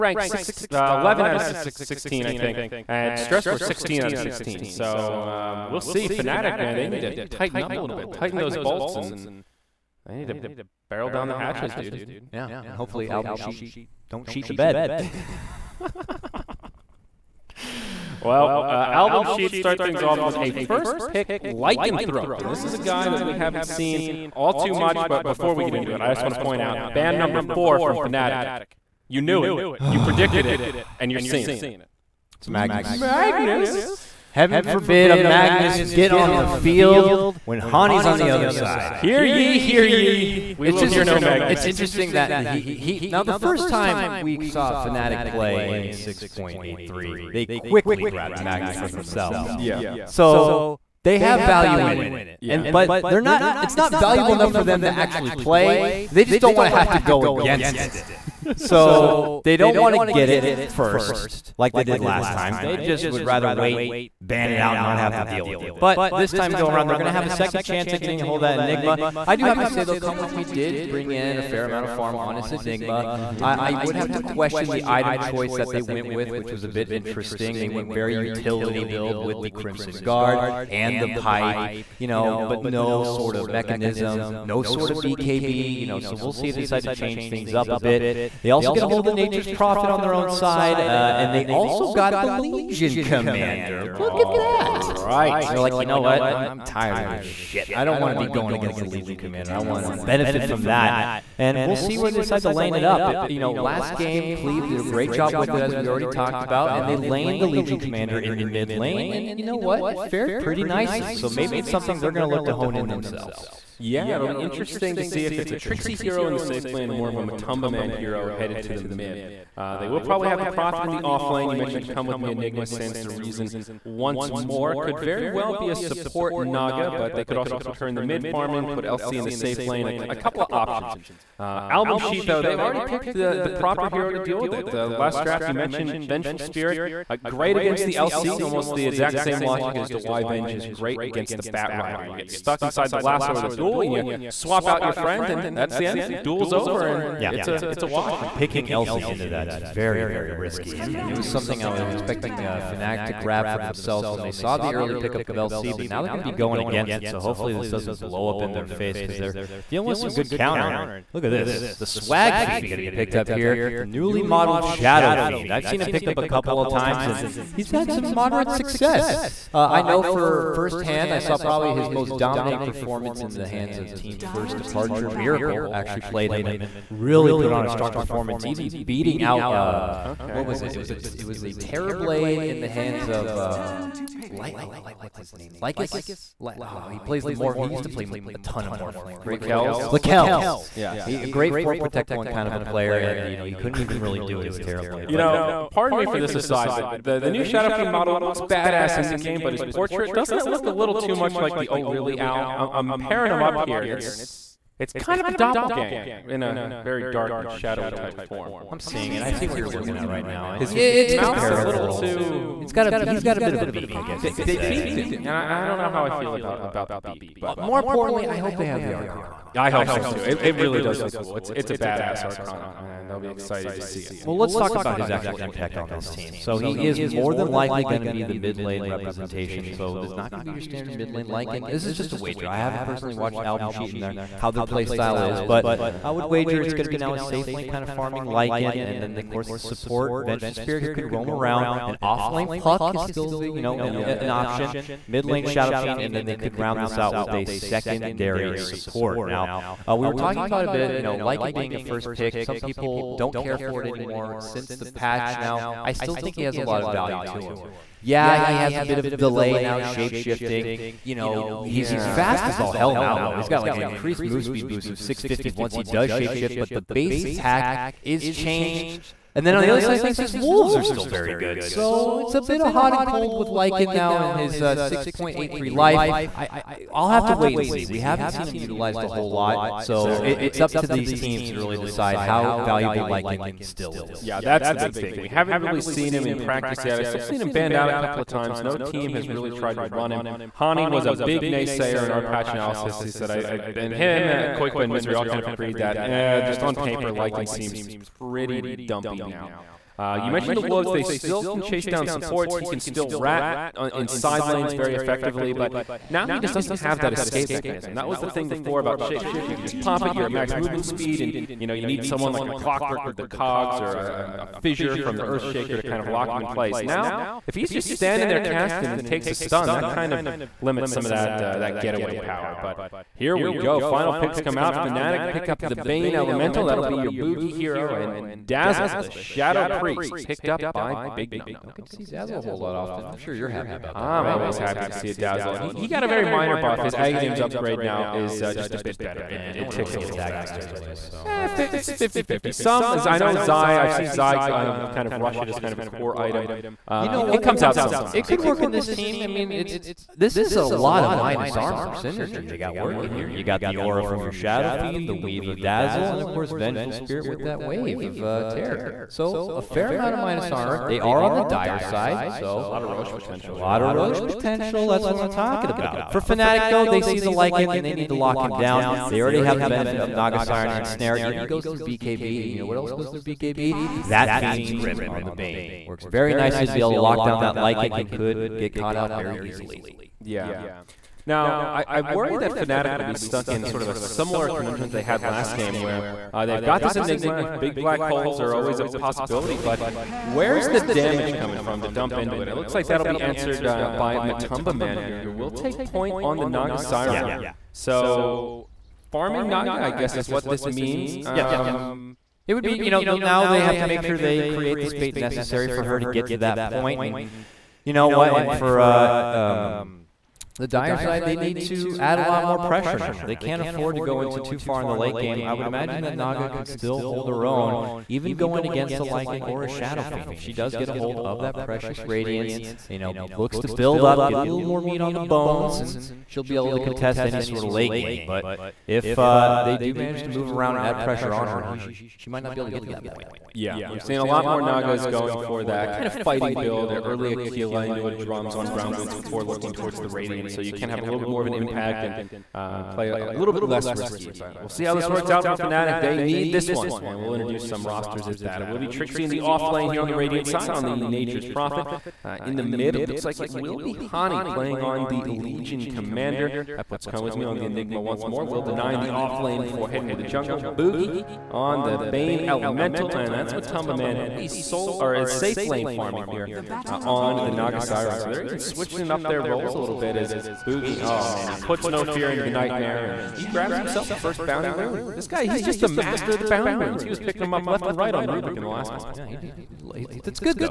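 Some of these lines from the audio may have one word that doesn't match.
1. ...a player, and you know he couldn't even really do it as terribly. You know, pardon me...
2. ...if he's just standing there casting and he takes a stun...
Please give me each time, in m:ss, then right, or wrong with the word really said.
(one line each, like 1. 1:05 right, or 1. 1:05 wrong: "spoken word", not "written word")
1. 3:12 right
2. 5:17 right.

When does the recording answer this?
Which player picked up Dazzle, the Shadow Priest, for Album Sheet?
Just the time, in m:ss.
5:31.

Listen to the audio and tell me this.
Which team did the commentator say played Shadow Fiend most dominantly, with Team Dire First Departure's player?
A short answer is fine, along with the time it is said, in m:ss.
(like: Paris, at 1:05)
Team Miracle, at 2:55.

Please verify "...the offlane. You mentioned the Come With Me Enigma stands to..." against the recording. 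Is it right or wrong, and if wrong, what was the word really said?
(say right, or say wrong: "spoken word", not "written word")
right.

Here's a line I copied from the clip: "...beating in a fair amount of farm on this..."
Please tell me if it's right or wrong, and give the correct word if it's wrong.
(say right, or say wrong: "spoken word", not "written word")
wrong: "bring", not "beating".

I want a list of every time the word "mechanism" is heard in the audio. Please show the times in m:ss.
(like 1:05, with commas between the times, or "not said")
1:23, 5:07.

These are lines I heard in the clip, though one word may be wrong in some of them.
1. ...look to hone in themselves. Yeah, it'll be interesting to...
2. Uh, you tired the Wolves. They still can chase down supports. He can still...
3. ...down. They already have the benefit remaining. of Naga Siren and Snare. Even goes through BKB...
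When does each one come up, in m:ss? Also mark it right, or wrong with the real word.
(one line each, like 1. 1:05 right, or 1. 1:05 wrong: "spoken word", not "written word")
1. 1:52 right
2. 4:59 wrong: "mentioned", not "tired"
3. 6:08 right.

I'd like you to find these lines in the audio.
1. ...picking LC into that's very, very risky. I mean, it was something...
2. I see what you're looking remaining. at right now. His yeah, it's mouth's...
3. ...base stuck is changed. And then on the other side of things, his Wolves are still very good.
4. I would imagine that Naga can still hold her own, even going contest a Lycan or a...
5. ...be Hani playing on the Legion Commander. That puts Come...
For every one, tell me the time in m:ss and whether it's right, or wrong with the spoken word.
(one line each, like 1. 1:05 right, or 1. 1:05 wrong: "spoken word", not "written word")
1. 2:28 right
2. 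3:29 right
3. 4:26 wrong: "attack", not "stuck"
4. 6:55 wrong: "against", not "contest"
5. 7:33 right.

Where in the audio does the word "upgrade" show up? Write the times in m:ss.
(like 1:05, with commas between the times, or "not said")
5:37.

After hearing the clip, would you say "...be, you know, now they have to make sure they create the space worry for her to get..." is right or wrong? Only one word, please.
wrong.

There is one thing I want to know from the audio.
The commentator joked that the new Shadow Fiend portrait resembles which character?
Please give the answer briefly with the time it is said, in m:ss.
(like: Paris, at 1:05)
Oh Really Owl, at 3:21.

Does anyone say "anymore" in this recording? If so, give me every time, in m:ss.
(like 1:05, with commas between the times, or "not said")
4:13.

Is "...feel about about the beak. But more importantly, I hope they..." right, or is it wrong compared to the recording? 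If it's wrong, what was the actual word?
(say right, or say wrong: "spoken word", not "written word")
right.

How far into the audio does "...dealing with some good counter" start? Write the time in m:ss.
2:39.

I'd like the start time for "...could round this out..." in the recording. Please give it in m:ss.
4:06.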